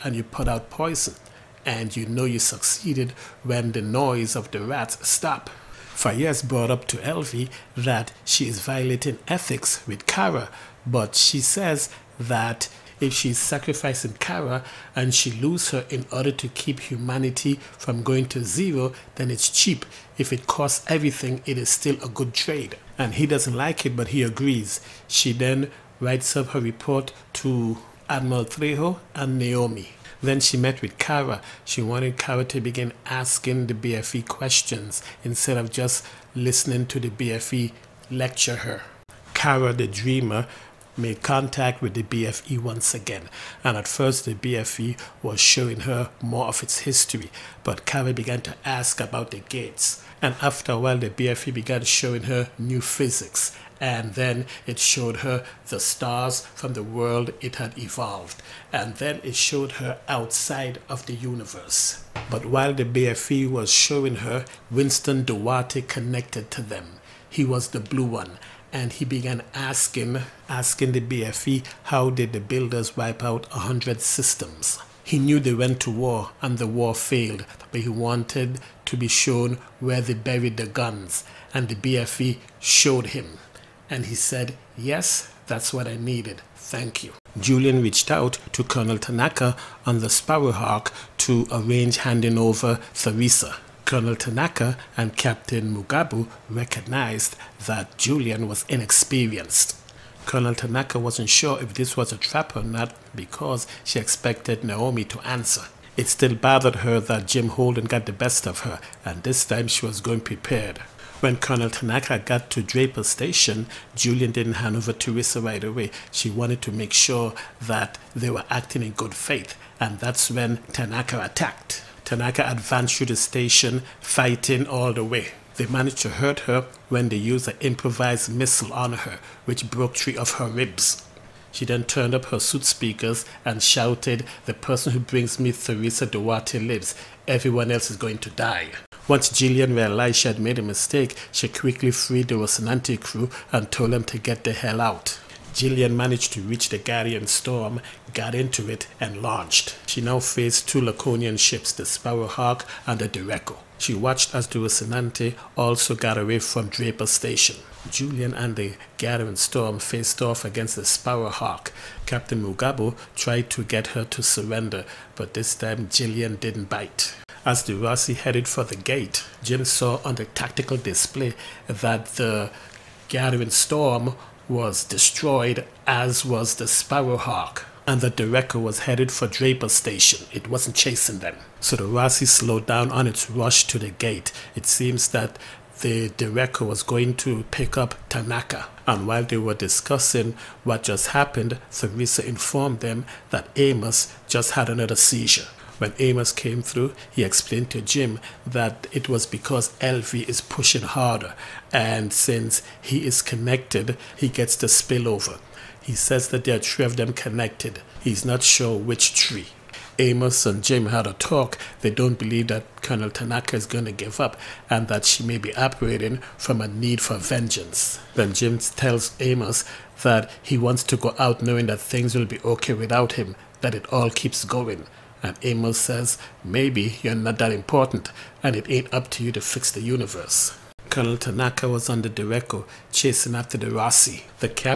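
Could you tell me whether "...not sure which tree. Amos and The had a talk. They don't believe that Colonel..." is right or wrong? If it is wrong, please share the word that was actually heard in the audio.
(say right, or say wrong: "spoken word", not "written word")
wrong: "Jim", not "The".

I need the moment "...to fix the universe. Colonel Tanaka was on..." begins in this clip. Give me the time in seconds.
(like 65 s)
229 s.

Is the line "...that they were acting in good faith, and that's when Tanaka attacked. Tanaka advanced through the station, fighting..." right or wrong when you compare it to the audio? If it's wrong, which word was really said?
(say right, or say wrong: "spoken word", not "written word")
right.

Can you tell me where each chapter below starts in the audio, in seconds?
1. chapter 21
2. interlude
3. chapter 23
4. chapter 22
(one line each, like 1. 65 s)
1. 87 s
2. 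39 s
3. 168 s
4. 138 s.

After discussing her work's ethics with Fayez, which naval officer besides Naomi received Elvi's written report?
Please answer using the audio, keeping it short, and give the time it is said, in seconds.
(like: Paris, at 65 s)
Admiral Trejo, at 28 s.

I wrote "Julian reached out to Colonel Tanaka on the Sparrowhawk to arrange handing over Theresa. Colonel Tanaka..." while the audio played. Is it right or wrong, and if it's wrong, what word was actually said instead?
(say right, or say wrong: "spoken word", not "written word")
right.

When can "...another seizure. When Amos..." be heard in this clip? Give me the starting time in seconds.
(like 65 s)
194 s.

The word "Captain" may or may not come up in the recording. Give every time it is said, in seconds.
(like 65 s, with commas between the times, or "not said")
95 s, 162 s.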